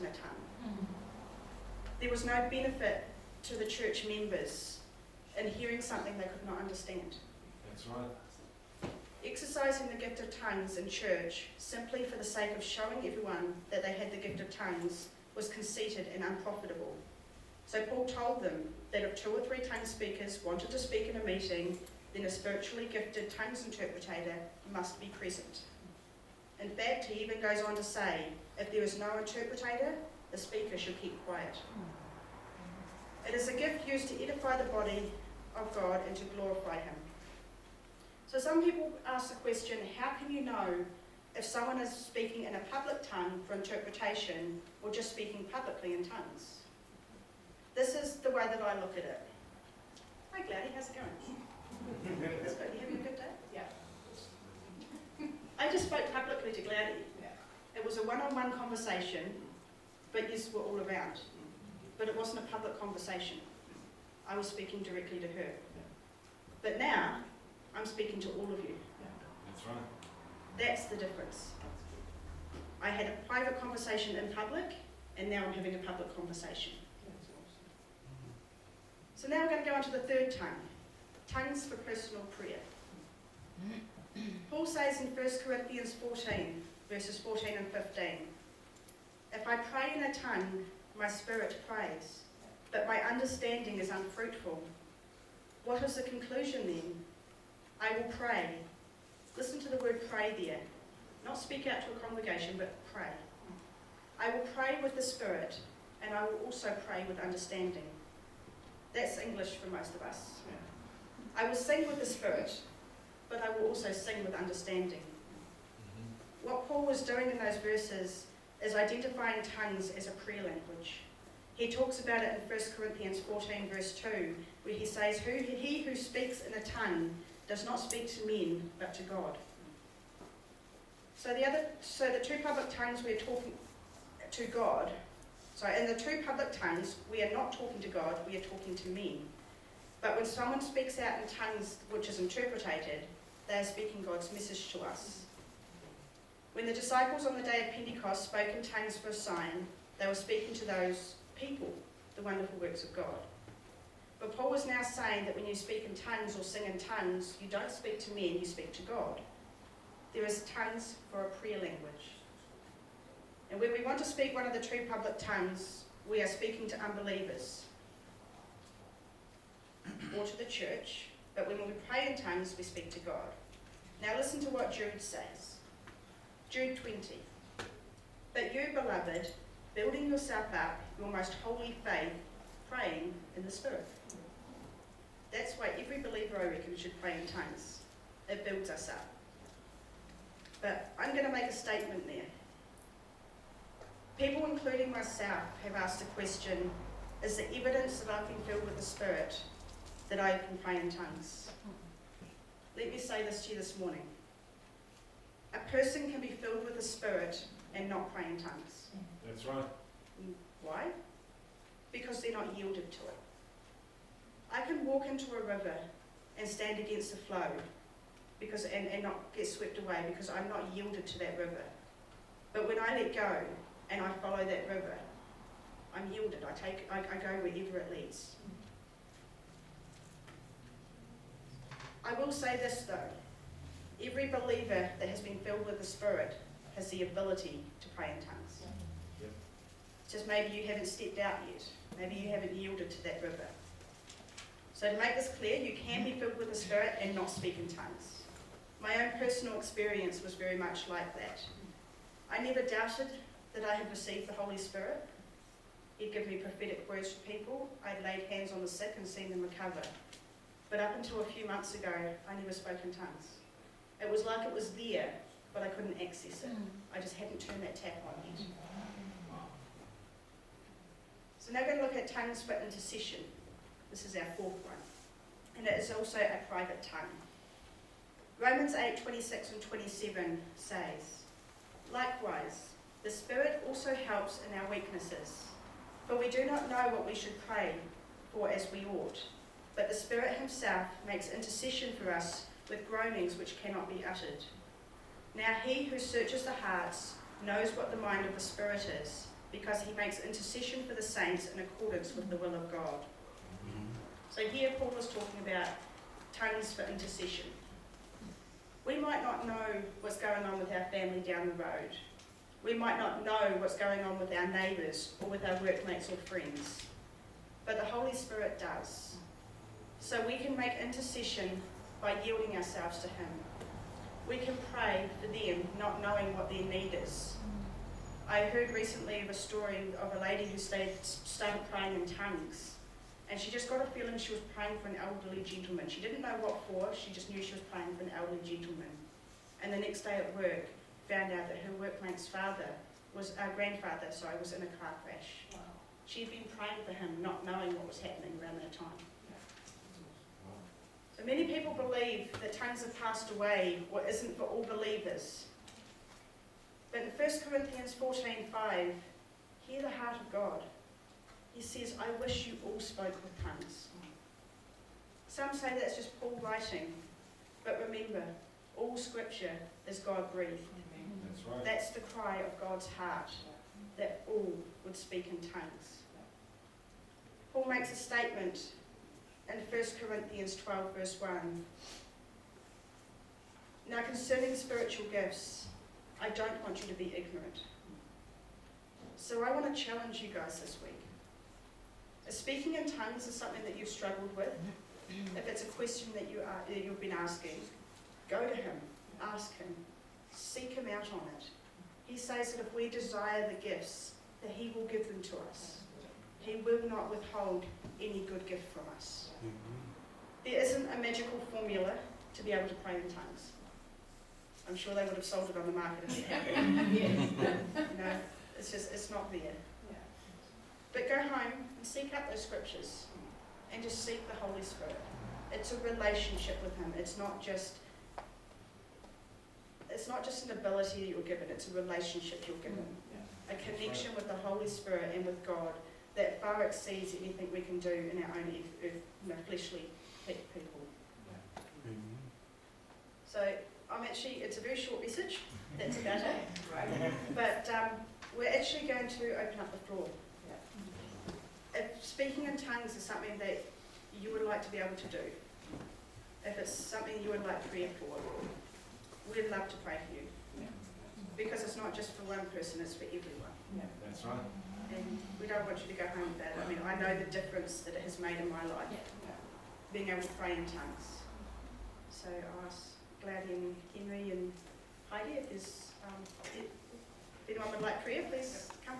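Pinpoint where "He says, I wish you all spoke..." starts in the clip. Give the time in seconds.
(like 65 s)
361 s.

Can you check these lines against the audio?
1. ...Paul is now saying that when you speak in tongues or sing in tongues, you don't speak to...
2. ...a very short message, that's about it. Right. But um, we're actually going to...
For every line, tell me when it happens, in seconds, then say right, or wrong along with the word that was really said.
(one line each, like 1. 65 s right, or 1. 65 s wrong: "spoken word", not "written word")
1. 154 s right
2. 444 s right.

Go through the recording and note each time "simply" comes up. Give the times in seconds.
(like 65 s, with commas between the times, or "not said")
11 s.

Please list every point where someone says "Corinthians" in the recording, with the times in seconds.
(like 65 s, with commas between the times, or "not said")
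85 s, 122 s, 357 s, 380 s.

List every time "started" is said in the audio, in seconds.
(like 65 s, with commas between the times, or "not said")
331 s.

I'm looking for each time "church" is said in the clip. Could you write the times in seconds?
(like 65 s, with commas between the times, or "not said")
3 s, 10 s, 170 s.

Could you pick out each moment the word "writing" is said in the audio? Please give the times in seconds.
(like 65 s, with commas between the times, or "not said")
366 s.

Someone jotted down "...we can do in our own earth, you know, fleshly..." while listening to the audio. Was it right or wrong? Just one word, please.
right.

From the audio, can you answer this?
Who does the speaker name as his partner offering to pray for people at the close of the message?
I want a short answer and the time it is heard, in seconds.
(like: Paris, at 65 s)
Heidi, at 475 s.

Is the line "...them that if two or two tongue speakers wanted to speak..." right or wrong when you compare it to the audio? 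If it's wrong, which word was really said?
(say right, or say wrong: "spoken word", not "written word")
wrong: "three", not "two".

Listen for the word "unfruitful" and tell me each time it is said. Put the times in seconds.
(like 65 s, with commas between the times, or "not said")
93 s.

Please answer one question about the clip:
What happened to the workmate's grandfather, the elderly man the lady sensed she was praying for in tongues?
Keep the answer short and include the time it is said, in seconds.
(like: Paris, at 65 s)
A car crash, at 344 s.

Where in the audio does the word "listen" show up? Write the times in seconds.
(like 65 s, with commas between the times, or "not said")
99 s, 174 s.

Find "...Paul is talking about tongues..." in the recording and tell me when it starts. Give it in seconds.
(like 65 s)
304 s.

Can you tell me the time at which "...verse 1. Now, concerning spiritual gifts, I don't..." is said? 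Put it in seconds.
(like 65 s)
380 s.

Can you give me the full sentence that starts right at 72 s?
I had a private conversation in public, and now I'm having a public conversation.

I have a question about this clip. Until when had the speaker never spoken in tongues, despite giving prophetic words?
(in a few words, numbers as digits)
A few months ago.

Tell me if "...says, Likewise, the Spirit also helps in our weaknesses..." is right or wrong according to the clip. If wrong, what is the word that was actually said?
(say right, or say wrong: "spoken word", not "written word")
right.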